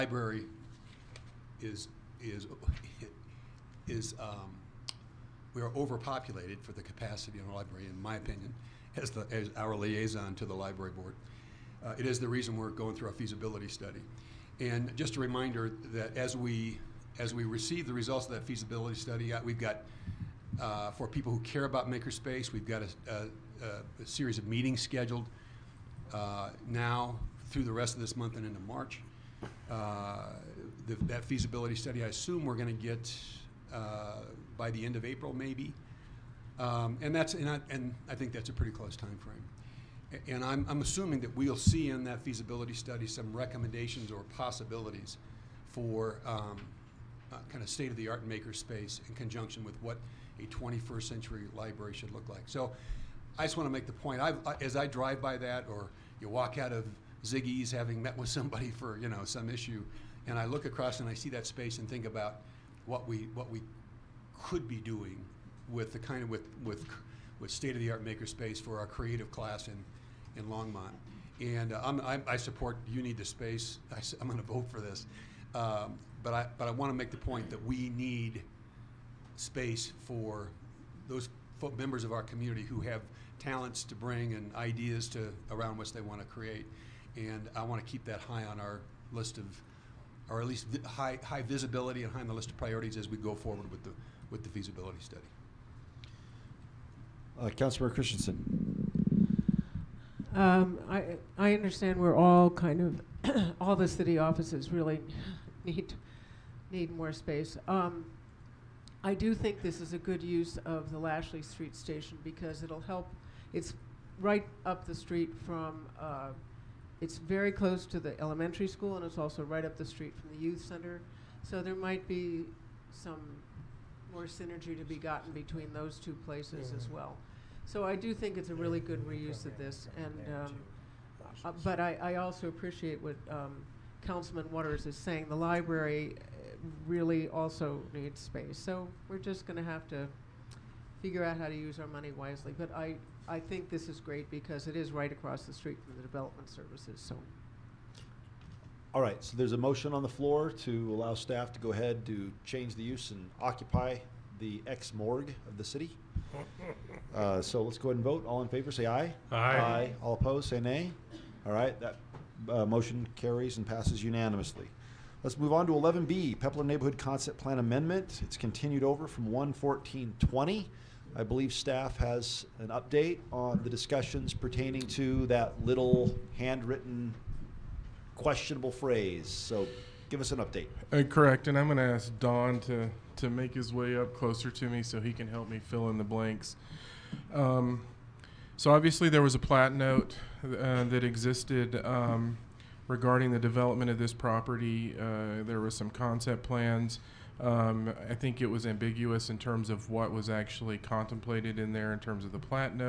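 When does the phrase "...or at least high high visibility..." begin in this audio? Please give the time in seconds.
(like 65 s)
90 s.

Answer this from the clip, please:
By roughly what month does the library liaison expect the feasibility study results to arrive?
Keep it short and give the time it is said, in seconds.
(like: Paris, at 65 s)
April, at 35 s.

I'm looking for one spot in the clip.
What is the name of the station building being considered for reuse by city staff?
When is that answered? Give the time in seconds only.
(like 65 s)
110 s.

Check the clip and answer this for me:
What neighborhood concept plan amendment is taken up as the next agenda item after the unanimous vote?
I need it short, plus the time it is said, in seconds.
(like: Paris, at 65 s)
Pepler, at 166 s.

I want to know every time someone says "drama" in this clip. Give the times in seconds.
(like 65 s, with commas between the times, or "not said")
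not said.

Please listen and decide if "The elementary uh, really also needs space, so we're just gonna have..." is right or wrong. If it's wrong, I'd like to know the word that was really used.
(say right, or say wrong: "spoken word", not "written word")
wrong: "library", not "elementary".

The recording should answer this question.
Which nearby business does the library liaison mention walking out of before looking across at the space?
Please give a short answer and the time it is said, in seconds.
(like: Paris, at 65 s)
Ziggi's, at 57 s.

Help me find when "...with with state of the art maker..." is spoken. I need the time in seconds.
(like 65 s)
66 s.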